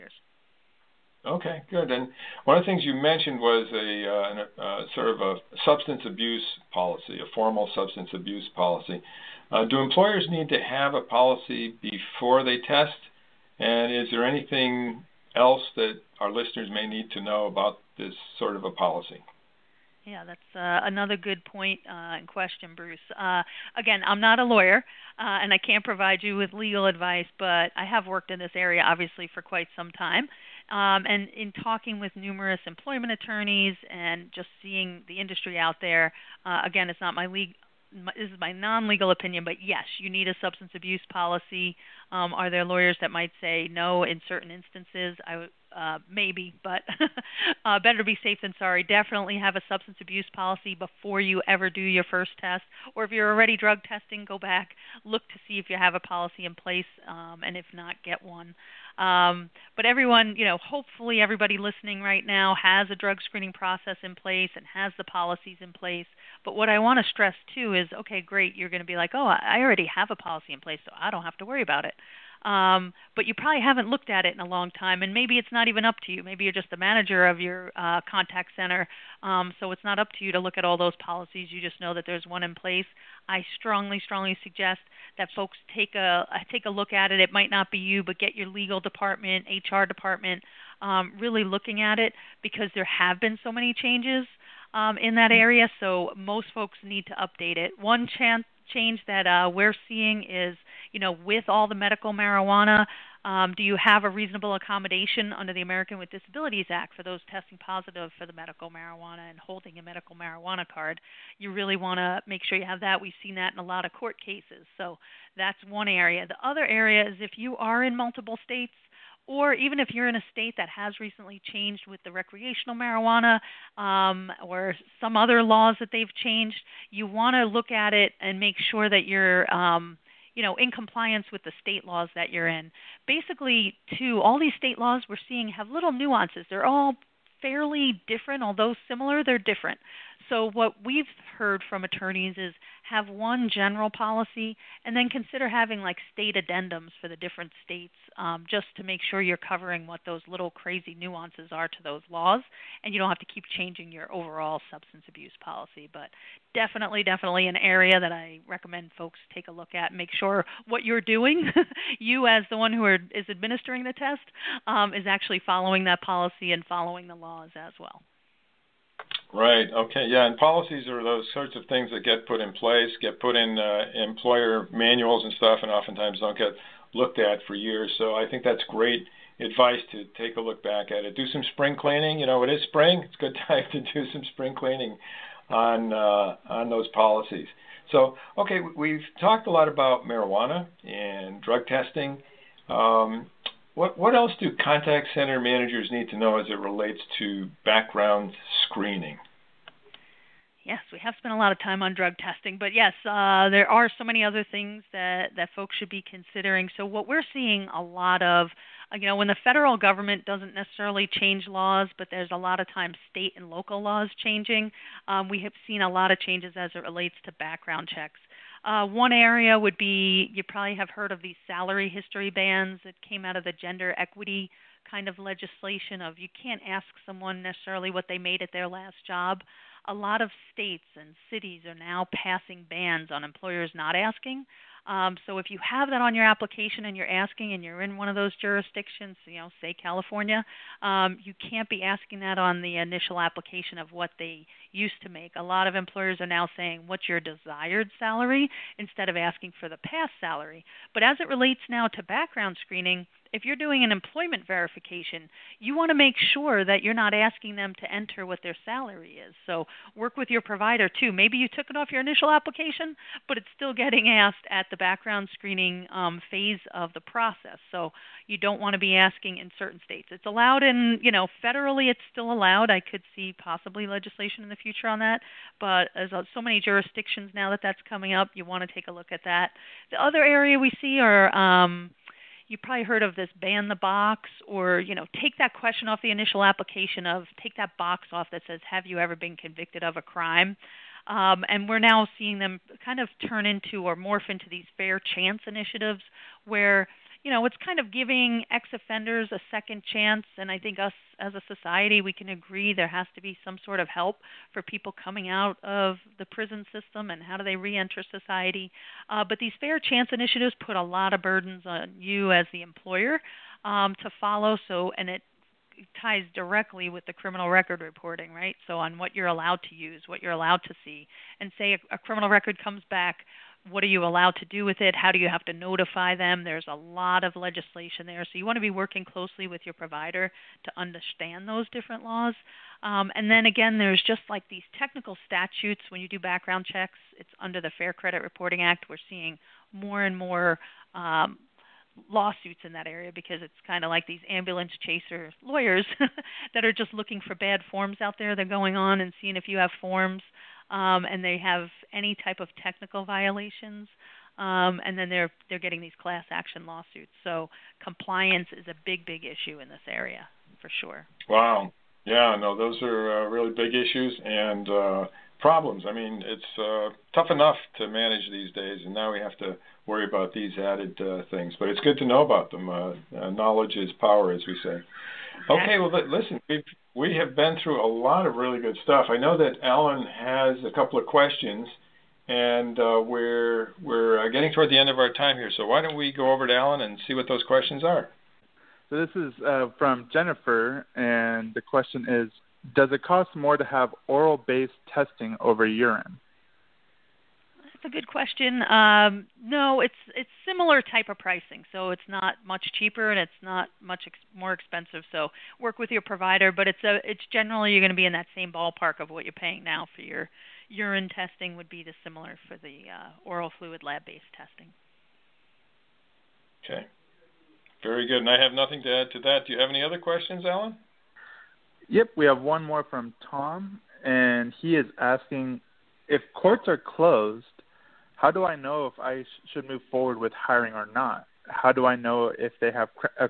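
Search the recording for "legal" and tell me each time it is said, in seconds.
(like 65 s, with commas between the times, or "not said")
26 s, 38 s, 88 s.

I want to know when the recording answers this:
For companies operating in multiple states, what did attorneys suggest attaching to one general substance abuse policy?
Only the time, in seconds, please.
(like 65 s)
146 s.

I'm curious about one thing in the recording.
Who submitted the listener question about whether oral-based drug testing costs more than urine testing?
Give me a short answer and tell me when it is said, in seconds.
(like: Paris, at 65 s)
Jennifer, at 390 s.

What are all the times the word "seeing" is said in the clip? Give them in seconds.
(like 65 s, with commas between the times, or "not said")
34 s, 99 s, 135 s, 207 s, 292 s, 339 s, 349 s.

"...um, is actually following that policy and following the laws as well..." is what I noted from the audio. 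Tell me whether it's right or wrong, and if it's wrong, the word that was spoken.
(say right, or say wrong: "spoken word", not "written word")
right.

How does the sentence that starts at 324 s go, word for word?
How do you have to notify them?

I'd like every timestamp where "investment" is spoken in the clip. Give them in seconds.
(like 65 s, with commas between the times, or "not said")
not said.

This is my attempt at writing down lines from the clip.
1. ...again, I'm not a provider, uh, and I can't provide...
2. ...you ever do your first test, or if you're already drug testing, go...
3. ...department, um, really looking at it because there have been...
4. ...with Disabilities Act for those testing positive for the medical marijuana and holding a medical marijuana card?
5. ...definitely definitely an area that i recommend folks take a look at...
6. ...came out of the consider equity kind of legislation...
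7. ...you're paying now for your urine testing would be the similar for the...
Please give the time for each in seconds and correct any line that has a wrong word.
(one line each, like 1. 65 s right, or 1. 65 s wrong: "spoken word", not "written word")
1. 23 s wrong: "lawyer", not "provider"
2. 51 s right
3. 89 s right
4. 105 s right
5. 156 s right
6. 223 s wrong: "gender", not "consider"
7. 409 s right.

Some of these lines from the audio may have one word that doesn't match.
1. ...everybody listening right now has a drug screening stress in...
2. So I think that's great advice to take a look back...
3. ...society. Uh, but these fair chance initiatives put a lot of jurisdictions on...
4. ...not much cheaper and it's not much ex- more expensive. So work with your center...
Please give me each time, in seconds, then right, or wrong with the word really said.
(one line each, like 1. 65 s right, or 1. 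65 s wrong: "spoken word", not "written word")
1. 61 s wrong: "process", not "stress"
2. 177 s right
3. 308 s wrong: "burdens", not "jurisdictions"
4. 402 s wrong: "provider", not "center".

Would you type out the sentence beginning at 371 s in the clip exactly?
But it's good to know about them.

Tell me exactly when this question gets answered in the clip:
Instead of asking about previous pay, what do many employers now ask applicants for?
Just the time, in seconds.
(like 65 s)
247 s.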